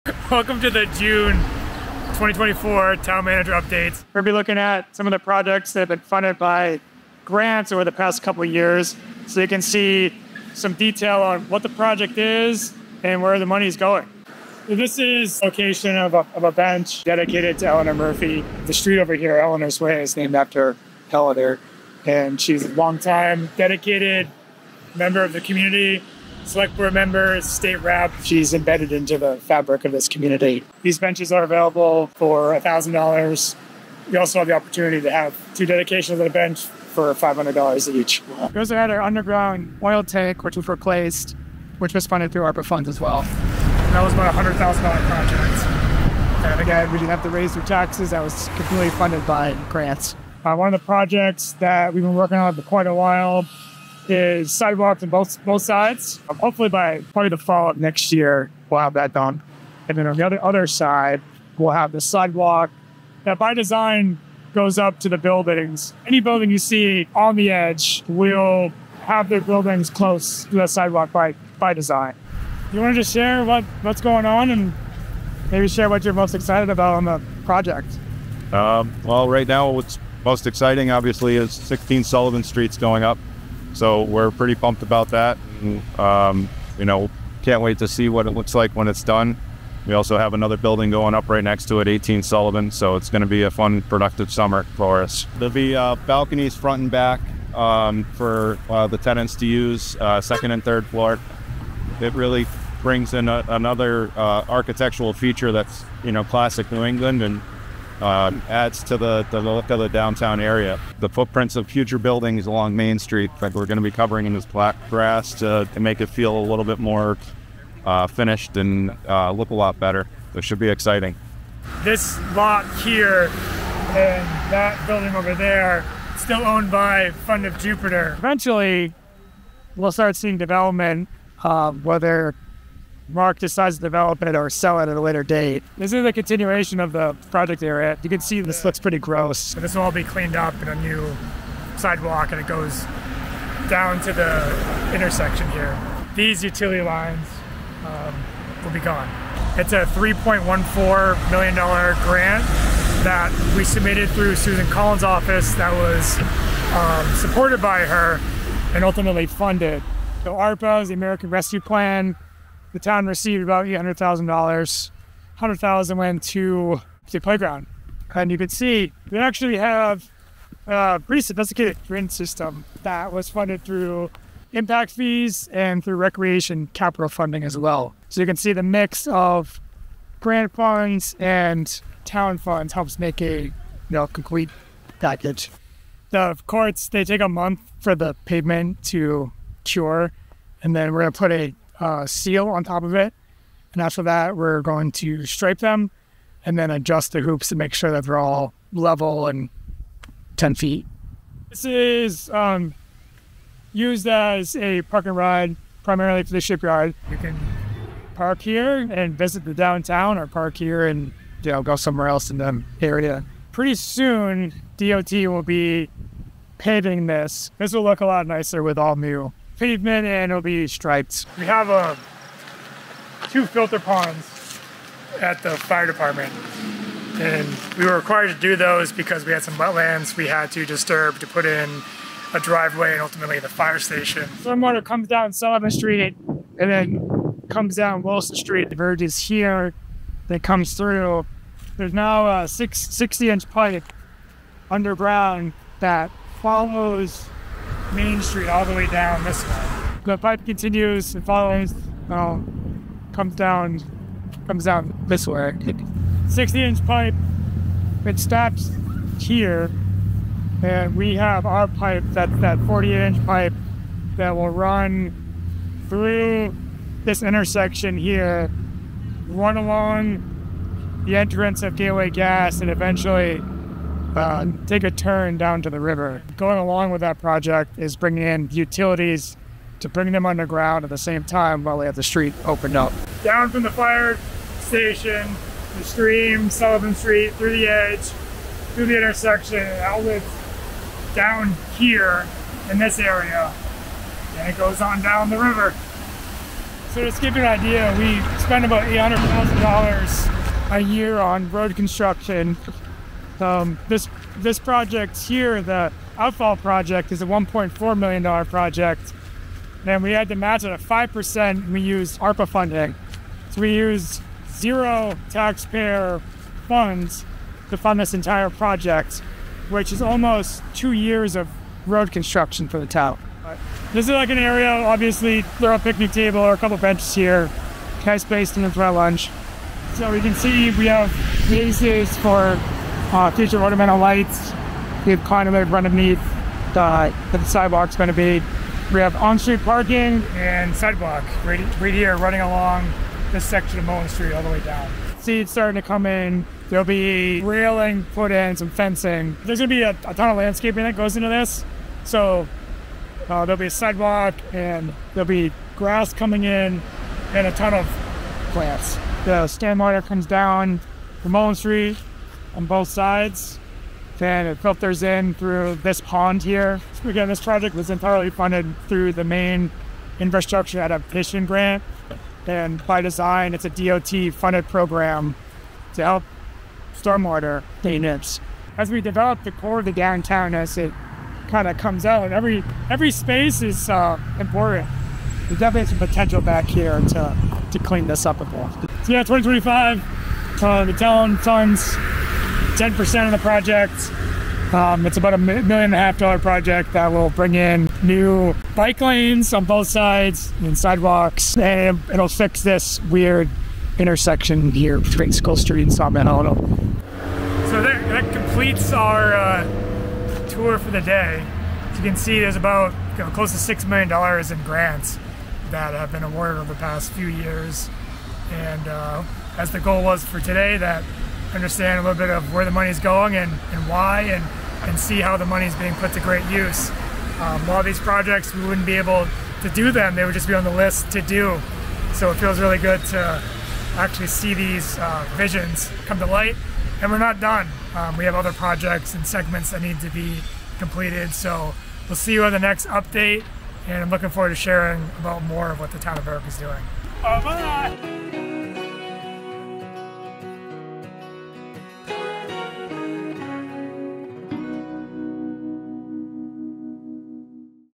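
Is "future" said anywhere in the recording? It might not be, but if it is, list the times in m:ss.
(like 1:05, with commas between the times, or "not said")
1:51, 5:33.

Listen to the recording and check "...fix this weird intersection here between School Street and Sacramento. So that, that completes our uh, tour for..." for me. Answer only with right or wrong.
right.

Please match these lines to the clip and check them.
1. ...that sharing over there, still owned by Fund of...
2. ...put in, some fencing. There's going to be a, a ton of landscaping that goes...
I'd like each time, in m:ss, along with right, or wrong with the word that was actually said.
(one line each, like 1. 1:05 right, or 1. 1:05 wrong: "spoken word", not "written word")
1. 2:04 wrong: "building", not "sharing"
2. 5:48 right.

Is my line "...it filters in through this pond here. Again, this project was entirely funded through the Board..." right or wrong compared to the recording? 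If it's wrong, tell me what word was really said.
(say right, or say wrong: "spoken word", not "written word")
wrong: "Maine", not "Board".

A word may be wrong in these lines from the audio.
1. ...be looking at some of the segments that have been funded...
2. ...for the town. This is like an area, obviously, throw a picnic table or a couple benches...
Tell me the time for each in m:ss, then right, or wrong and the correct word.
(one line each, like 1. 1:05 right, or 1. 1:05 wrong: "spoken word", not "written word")
1. 0:04 wrong: "projects", not "segments"
2. 5:22 right.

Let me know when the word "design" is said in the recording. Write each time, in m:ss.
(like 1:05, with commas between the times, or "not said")
1:03, 1:11, 6:13.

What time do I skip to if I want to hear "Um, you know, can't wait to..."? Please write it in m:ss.
1:25.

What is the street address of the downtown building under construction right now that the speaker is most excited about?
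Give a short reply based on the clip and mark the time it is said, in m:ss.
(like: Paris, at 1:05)
16 Sullivan Street, at 1:21.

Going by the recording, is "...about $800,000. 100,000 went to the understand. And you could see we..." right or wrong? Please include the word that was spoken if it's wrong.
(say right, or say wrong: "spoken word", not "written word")
wrong: "playground", not "understand".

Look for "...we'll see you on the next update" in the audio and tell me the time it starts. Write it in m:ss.
7:22.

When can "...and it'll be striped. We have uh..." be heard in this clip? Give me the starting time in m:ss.
3:40.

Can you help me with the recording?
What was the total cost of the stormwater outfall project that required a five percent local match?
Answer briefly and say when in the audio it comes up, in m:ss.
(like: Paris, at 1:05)
$1.4 million, at 5:07.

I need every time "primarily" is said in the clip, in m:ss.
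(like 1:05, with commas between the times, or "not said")
3:25.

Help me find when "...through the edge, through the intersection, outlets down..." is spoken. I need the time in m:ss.
4:47.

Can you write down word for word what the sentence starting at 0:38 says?
We also had our underground oil tank, which was replaced, which was funded through ARPA funds as well.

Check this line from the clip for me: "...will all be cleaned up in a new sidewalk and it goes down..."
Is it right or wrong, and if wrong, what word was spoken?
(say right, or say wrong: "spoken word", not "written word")
right.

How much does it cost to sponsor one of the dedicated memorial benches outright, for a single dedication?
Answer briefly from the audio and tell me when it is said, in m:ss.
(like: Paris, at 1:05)
$1,000, at 0:32.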